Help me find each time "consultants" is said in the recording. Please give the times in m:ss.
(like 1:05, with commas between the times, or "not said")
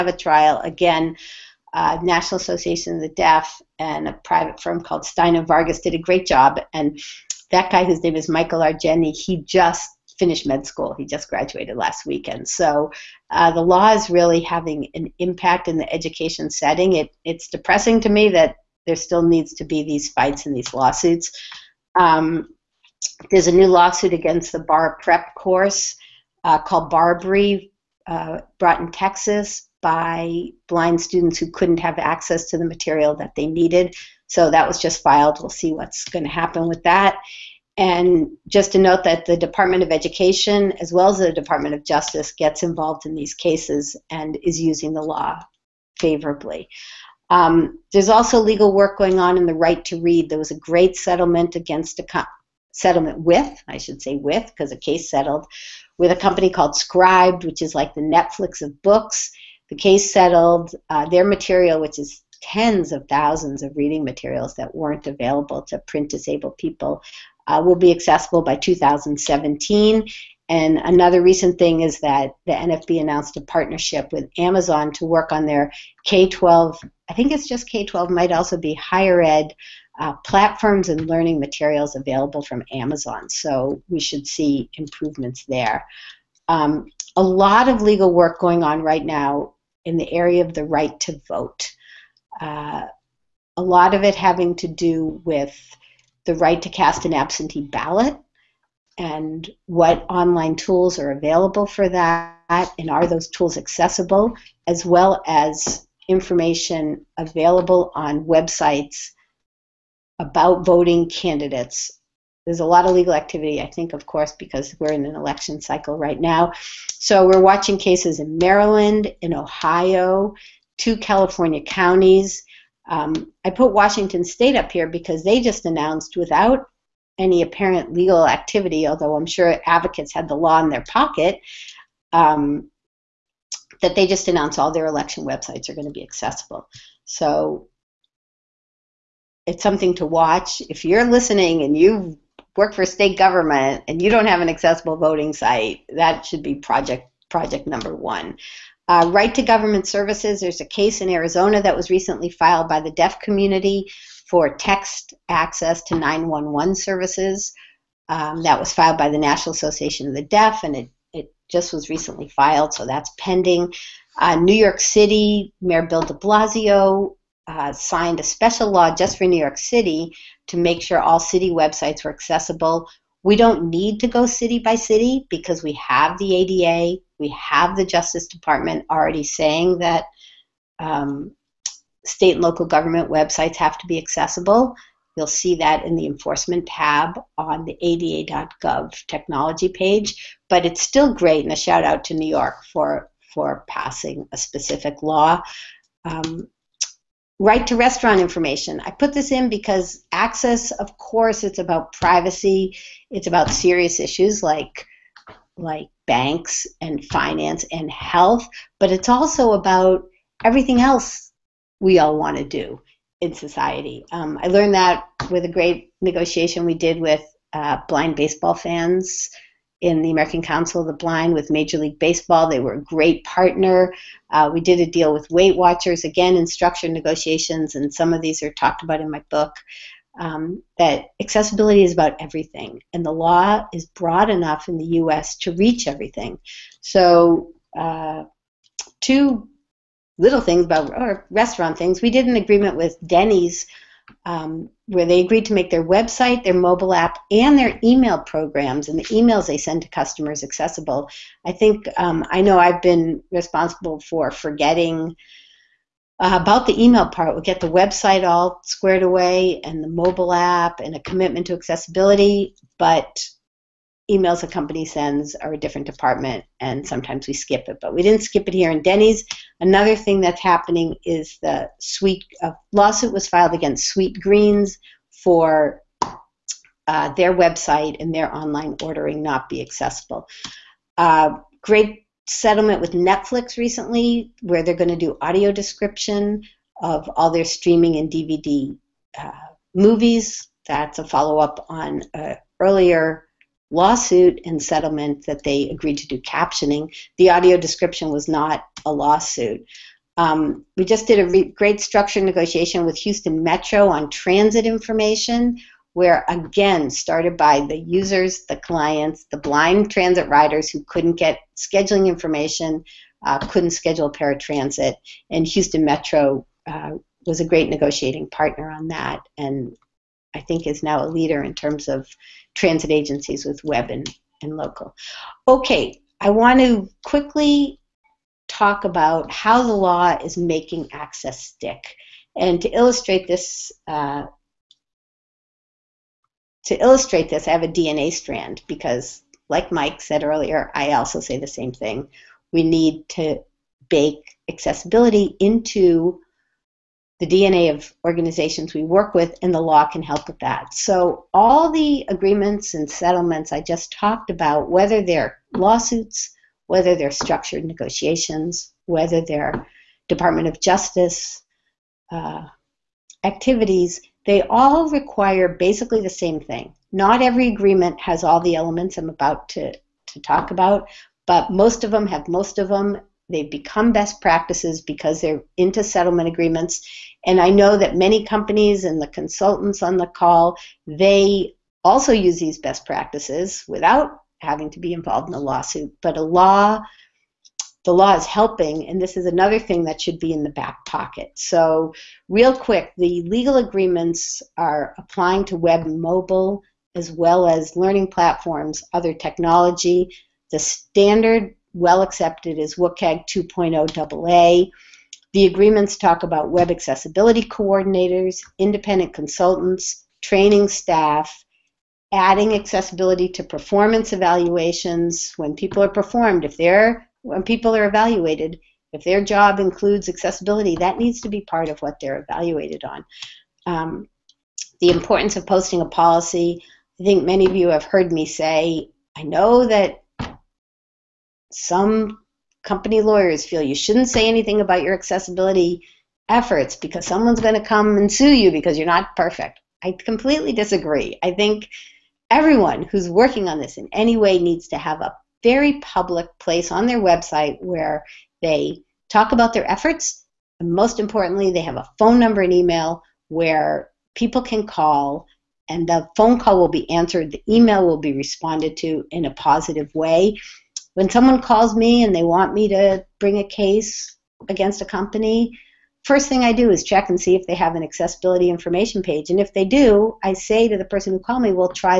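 6:19, 6:49.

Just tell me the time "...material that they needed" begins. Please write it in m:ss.
0:32.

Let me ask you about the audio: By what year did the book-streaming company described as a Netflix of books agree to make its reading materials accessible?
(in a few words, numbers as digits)
2017.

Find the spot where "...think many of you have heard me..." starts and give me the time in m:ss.
7:07.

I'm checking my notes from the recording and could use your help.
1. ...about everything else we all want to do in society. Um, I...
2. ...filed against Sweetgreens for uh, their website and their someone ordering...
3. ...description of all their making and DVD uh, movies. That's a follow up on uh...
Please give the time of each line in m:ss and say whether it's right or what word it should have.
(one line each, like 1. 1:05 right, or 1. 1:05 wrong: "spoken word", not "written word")
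1. 3:29 right
2. 4:33 wrong: "online", not "someone"
3. 4:45 wrong: "streaming", not "making".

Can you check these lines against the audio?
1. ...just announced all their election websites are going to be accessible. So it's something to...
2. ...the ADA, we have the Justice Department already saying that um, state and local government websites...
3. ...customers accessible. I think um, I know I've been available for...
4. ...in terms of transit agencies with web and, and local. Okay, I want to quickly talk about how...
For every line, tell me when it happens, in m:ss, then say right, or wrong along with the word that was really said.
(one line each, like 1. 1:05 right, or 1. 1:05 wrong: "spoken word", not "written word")
1. 2:14 right
2. 2:56 right
3. 4:09 wrong: "responsible", not "available"
4. 5:21 right.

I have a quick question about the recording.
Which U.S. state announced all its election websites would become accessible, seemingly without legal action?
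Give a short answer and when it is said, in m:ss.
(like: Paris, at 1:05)
Washington State, at 2:03.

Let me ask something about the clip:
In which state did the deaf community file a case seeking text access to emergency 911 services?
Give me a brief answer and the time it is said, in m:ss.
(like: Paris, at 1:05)
Arizona, at 2:31.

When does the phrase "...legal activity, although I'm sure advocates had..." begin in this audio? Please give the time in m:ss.
2:07.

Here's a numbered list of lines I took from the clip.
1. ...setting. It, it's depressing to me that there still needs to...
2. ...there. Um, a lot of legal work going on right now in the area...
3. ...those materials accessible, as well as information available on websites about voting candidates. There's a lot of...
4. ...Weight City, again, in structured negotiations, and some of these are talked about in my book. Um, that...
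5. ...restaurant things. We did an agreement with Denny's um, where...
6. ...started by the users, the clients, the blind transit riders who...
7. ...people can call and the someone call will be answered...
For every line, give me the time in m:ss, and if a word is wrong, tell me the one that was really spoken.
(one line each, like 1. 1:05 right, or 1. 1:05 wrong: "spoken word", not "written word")
1. 0:16 right
2. 1:25 right
3. 1:43 wrong: "tools", not "materials"
4. 3:45 wrong: "Watchers", not "City"
5. 4:01 right
6. 5:06 right
7. 7:34 wrong: "phone", not "someone".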